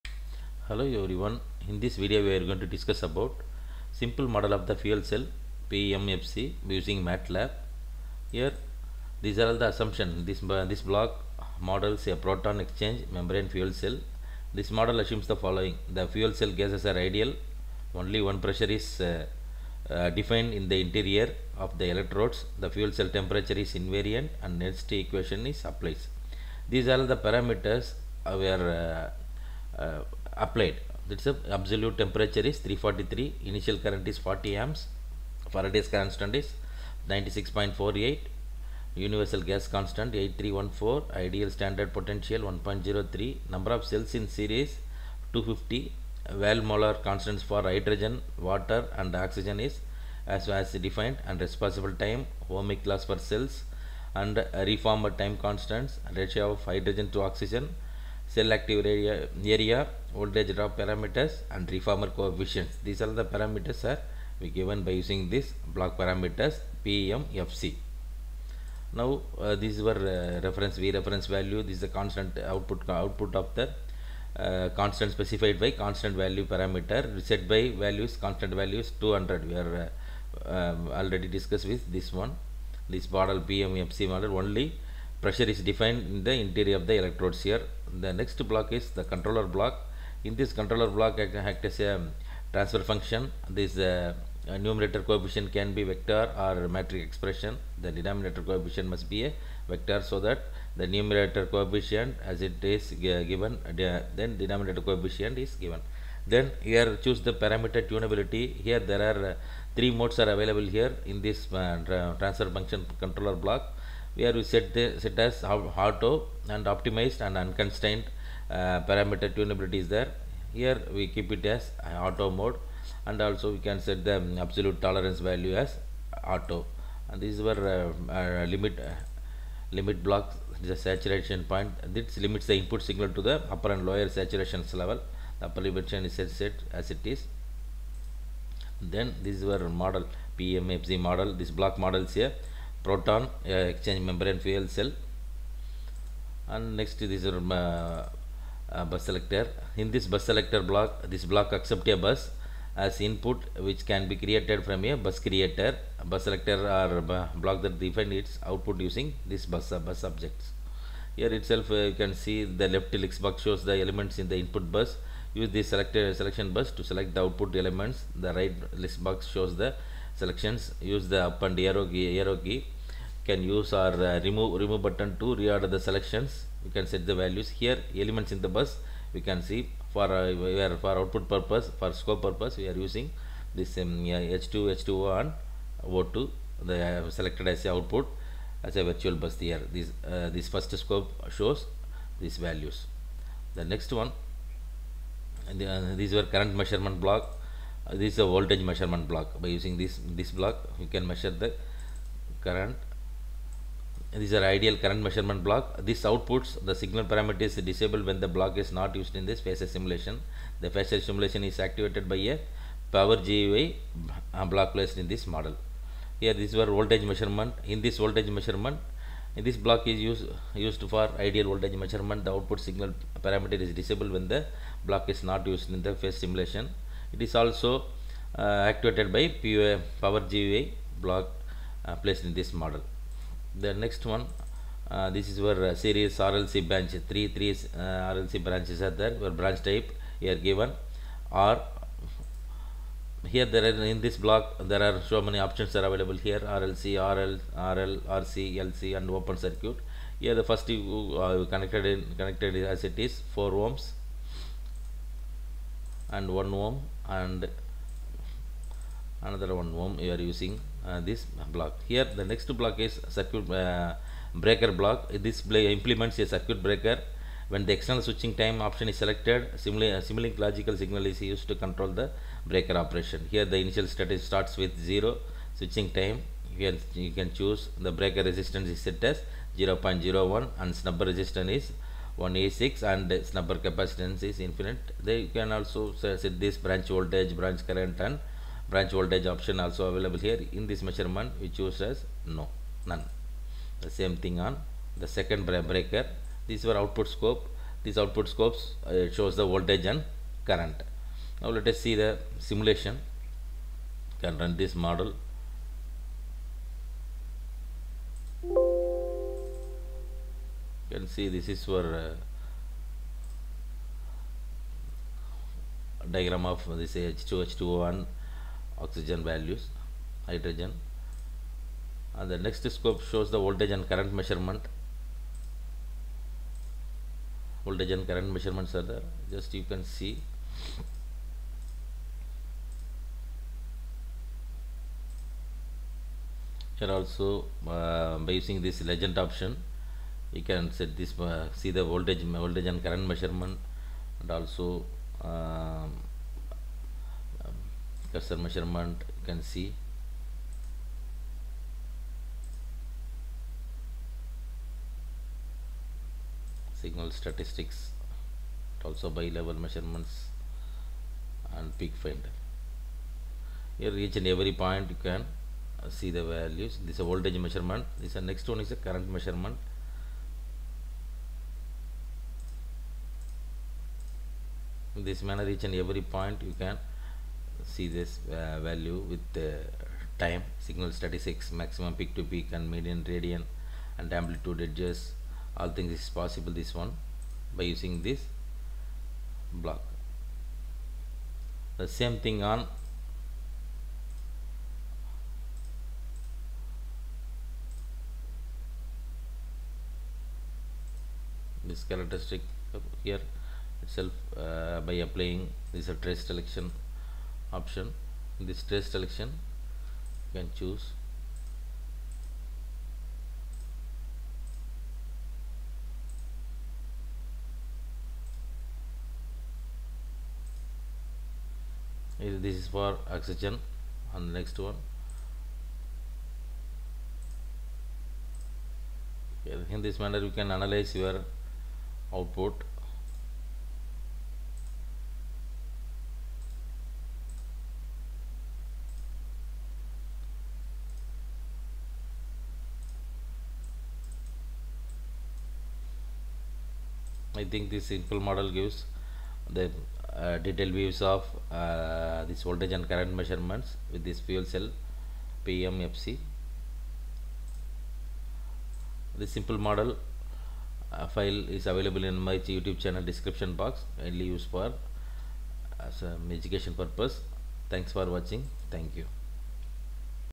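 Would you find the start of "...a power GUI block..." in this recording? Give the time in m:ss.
3:32.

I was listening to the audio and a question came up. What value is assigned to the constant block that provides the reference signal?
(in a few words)
200.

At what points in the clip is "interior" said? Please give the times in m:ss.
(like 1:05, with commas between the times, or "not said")
0:20, 1:26.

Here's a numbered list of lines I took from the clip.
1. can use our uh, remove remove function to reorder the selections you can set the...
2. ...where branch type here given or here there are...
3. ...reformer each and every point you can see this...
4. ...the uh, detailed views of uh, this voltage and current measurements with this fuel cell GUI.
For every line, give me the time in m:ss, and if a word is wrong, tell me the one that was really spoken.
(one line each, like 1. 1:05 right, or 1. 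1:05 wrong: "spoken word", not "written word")
1. 2:53 wrong: "button", not "function"
2. 3:59 right
3. 6:15 wrong: "manner", not "reformer"
4. 7:29 wrong: "PMFC", not "GUI".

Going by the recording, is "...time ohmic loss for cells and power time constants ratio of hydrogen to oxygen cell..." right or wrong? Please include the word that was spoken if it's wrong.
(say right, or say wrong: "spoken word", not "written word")
wrong: "reformer", not "power".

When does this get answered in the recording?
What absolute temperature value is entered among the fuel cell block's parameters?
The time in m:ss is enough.
0:32.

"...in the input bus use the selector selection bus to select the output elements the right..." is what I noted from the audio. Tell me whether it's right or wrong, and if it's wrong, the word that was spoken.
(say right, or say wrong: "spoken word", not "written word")
right.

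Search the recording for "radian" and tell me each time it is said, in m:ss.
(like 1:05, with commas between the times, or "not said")
6:23.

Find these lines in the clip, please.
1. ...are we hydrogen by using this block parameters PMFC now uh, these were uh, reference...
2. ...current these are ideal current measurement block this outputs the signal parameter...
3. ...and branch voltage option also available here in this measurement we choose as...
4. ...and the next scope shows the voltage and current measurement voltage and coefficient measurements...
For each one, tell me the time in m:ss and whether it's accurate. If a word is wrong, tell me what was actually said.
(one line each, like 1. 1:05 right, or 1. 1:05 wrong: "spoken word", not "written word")
1. 1:03 wrong: "given", not "hydrogen"
2. 3:22 right
3. 4:47 right
4. 5:22 wrong: "current", not "coefficient".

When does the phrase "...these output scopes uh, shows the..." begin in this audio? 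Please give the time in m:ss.
4:57.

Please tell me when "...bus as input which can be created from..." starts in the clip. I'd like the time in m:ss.
2:32.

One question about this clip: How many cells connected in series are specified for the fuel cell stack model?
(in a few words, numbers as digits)
250.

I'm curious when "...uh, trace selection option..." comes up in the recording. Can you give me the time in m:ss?
6:45.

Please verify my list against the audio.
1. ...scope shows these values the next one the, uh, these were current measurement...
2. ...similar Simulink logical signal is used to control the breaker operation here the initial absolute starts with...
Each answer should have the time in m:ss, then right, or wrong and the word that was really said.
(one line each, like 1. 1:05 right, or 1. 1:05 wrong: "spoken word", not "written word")
1. 3:10 right
2. 4:29 wrong: "state", not "absolute".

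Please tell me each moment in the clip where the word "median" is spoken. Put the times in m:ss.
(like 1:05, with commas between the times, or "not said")
6:22.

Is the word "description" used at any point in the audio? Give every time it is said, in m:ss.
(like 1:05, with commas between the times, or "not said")
7:43.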